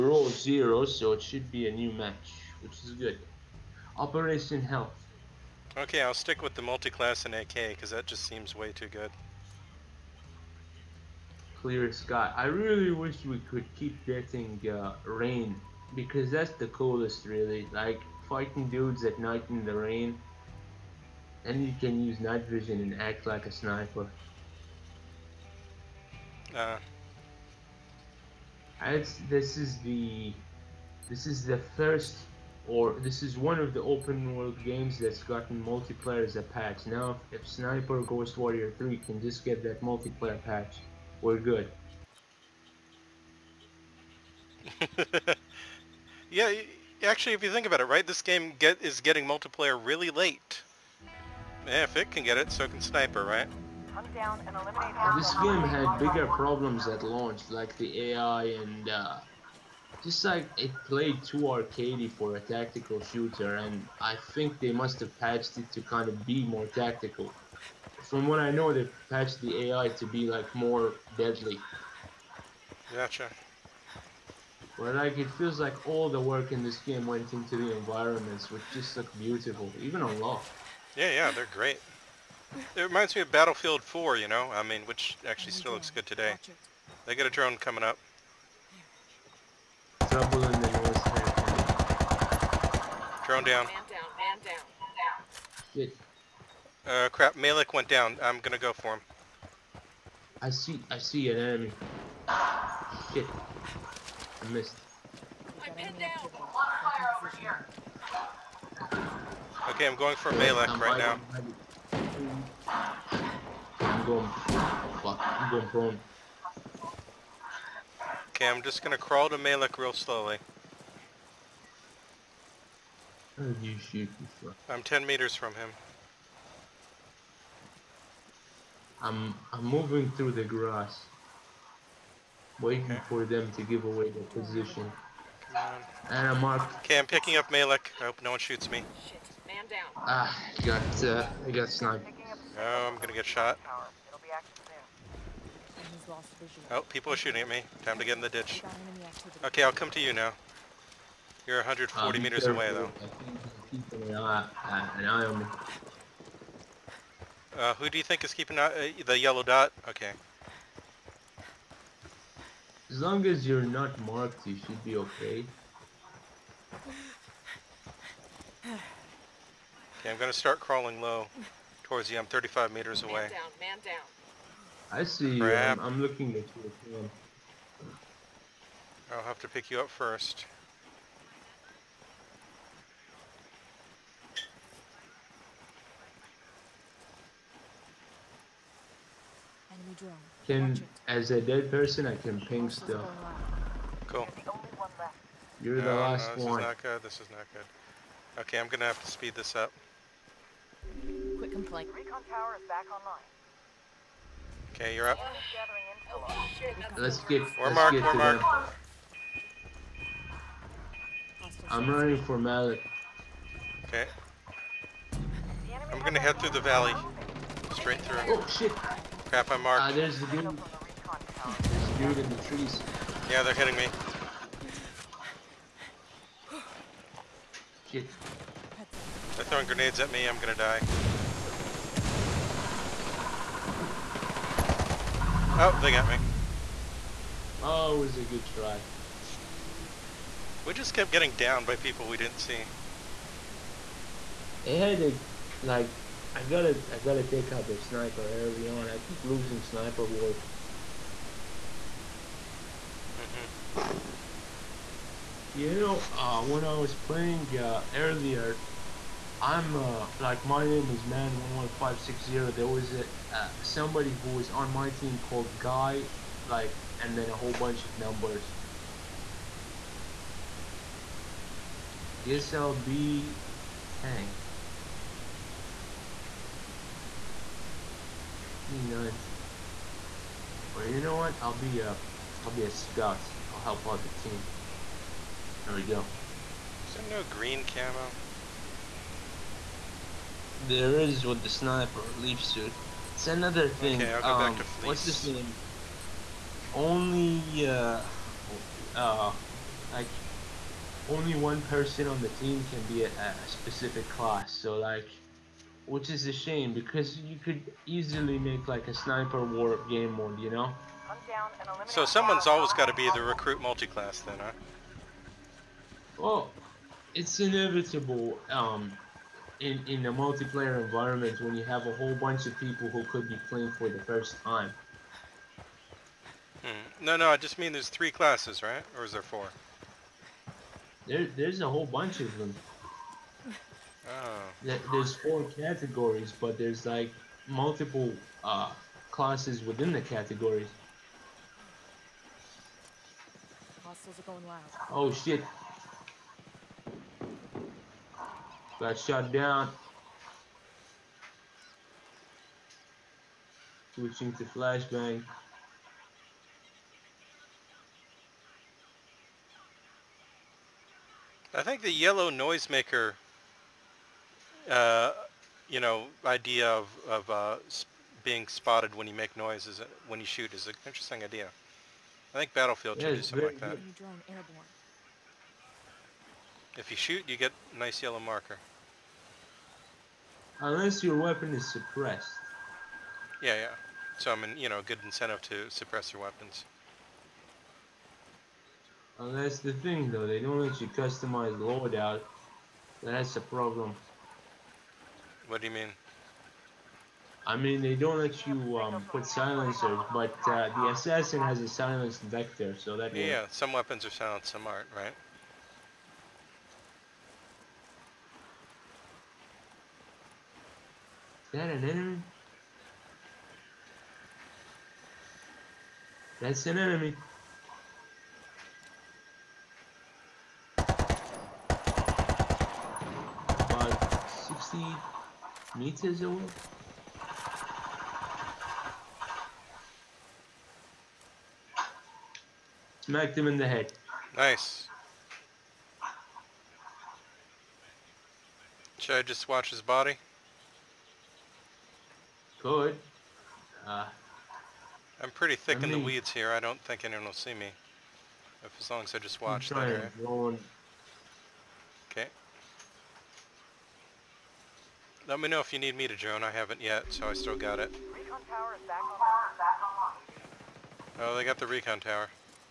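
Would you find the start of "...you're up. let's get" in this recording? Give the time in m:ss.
3:24.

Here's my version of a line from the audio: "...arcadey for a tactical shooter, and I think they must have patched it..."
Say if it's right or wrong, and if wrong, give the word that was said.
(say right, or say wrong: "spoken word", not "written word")
right.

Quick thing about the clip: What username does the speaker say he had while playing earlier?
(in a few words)
man11560.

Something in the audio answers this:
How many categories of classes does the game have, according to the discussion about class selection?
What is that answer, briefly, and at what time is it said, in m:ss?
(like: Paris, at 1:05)
4, at 5:35.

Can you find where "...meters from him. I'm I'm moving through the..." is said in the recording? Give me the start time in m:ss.
2:05.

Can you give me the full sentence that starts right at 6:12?
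I think Battlefield yeah, do something like that.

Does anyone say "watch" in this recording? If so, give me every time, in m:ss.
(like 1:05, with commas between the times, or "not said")
7:19, 7:29.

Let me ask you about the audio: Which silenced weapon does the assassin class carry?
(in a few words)
Vector.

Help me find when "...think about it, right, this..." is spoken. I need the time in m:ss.
0:47.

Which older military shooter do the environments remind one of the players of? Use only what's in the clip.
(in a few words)
Battlefield 4.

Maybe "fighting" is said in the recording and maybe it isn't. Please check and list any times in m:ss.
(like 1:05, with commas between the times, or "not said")
0:18.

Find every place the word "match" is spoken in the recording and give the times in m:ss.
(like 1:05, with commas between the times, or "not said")
0:01.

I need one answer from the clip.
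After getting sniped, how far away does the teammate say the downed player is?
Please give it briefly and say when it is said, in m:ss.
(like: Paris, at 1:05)
140 meters, at 2:31.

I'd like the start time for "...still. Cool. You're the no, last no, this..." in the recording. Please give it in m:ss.
3:12.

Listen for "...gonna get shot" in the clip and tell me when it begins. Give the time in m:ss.
2:22.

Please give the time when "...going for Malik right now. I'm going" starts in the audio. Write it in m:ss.
1:49.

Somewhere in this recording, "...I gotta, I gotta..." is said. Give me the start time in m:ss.
4:06.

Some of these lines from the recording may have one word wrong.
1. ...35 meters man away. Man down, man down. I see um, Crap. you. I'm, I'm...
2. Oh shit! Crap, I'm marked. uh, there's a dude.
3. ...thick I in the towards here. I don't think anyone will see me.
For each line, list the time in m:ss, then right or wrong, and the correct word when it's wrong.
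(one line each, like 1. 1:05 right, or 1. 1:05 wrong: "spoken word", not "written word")
1. 2:52 right
2. 3:38 right
3. 7:25 wrong: "weeds", not "towards".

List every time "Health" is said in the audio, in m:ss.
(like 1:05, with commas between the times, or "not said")
0:04.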